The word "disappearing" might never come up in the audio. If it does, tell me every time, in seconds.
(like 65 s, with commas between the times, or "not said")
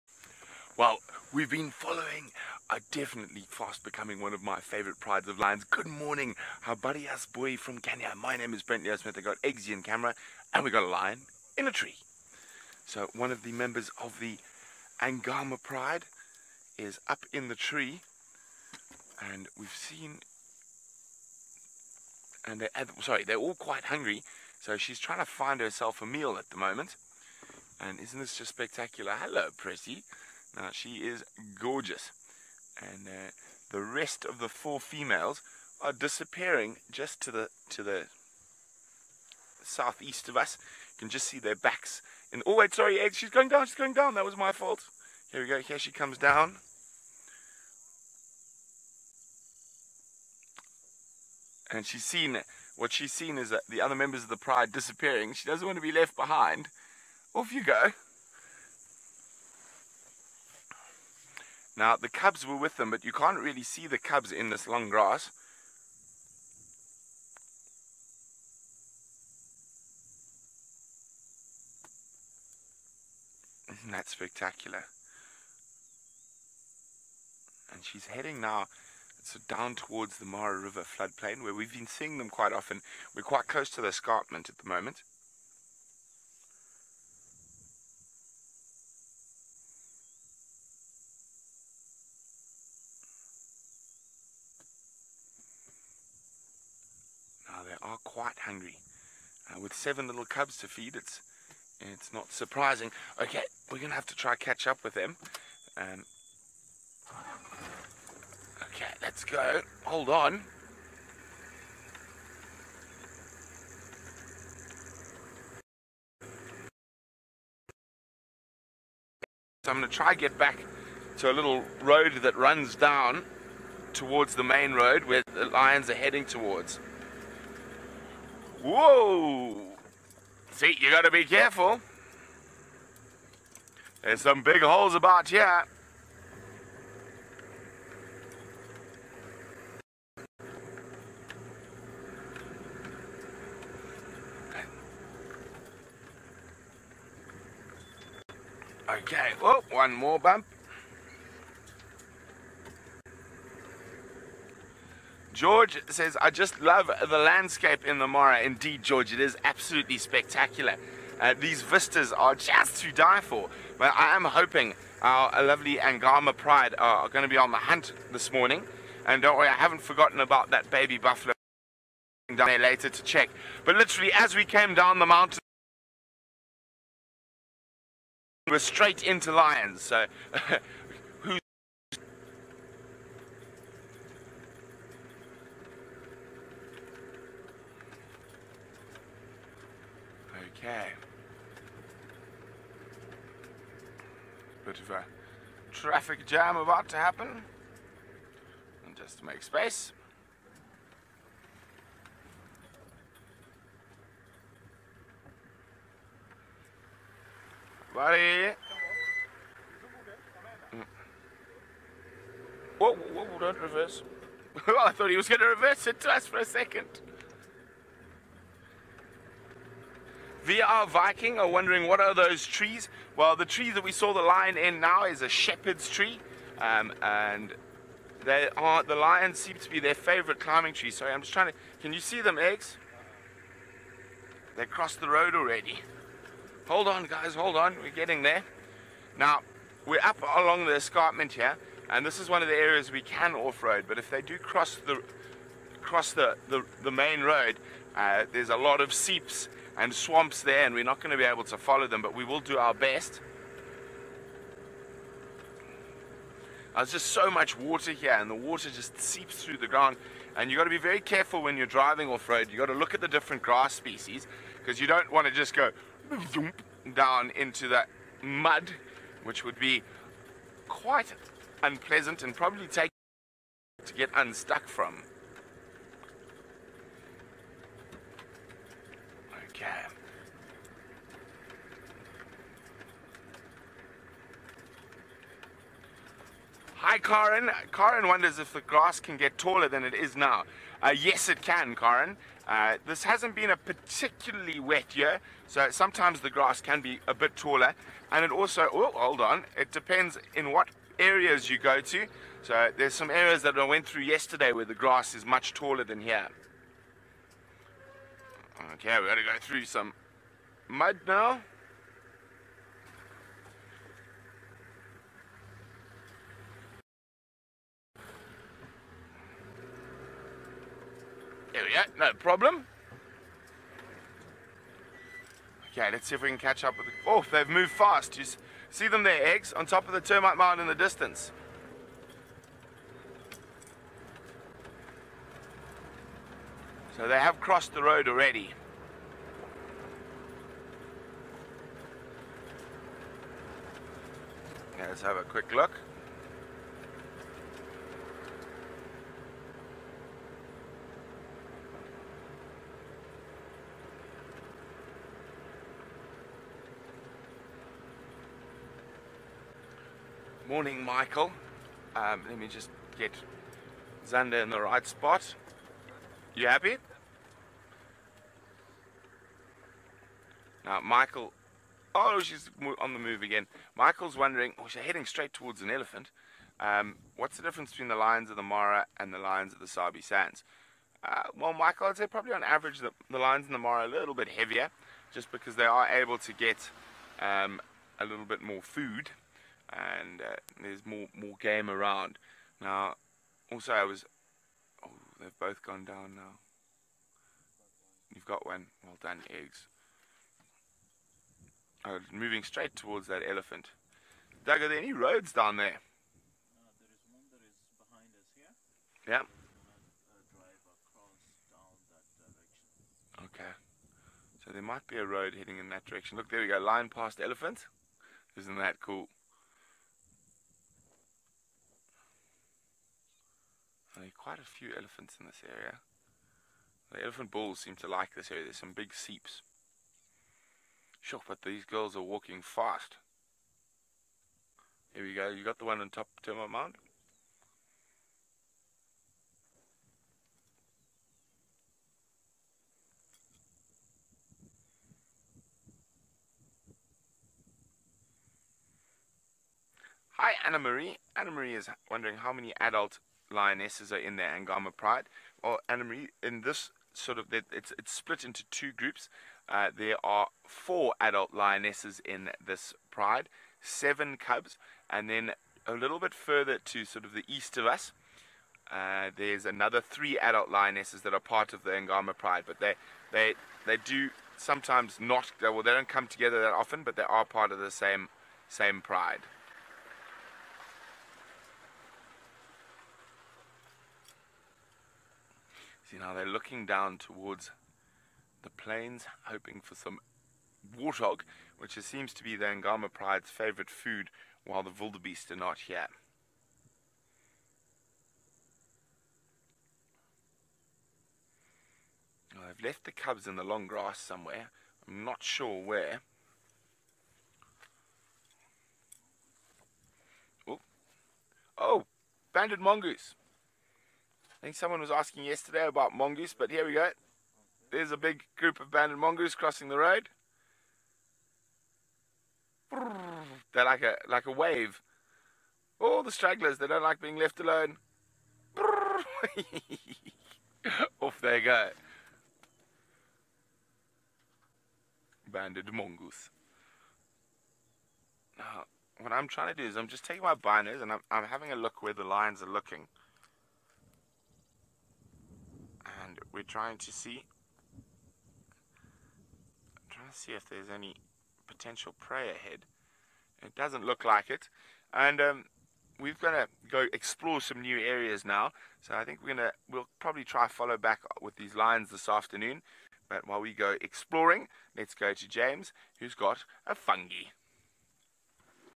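35 s, 54 s.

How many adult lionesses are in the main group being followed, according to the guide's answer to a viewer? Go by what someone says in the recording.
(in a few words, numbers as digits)
4.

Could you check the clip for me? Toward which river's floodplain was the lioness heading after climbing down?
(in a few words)
Mara River.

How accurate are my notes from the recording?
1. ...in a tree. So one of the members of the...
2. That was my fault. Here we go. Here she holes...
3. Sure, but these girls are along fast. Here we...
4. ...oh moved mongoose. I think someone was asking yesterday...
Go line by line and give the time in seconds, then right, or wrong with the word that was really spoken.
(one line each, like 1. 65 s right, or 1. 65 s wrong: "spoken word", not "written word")
1. 11 s right
2. 44 s wrong: "comes", not "holes"
3. 431 s wrong: "walking", not "along"
4. 511 s wrong: "banded", not "moved".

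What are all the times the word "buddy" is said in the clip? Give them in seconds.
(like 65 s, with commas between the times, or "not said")
6 s, 207 s.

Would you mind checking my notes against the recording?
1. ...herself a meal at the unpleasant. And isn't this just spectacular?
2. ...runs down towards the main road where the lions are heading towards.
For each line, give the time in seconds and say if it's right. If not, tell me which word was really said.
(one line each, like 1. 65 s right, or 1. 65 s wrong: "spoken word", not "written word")
1. 25 s wrong: "moment", not "unpleasant"
2. 122 s right.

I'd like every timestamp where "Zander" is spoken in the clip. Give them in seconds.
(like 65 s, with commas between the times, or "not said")
364 s.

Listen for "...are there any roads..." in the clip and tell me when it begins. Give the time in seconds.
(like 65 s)
404 s.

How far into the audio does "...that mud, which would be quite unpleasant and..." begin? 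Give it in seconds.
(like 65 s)
267 s.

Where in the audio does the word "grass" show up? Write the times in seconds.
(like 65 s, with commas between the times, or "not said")
64 s, 263 s, 288 s, 296 s, 304 s, 503 s.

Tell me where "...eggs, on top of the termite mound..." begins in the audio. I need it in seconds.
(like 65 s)
329 s.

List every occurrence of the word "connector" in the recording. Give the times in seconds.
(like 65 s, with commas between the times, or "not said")
not said.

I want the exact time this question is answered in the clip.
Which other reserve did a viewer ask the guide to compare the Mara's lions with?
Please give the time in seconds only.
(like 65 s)
379 s.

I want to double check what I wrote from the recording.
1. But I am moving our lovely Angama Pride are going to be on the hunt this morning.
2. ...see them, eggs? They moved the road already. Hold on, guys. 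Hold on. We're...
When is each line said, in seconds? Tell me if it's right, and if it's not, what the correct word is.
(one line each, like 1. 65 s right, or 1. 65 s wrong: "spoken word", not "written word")
1. 163 s wrong: "hoping", not "moving"
2. 231 s wrong: "crossed", not "moved".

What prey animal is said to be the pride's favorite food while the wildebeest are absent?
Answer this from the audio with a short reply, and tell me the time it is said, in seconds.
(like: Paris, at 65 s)
Warthog, at 490 s.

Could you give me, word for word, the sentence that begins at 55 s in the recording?
She doesn't want to be left behind.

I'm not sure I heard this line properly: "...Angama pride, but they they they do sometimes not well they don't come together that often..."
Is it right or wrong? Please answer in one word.
right.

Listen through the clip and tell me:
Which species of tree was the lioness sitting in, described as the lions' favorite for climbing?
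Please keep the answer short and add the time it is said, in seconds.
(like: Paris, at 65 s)
Shepherd's tree, at 225 s.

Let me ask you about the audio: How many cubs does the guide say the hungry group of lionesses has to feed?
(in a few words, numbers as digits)
7.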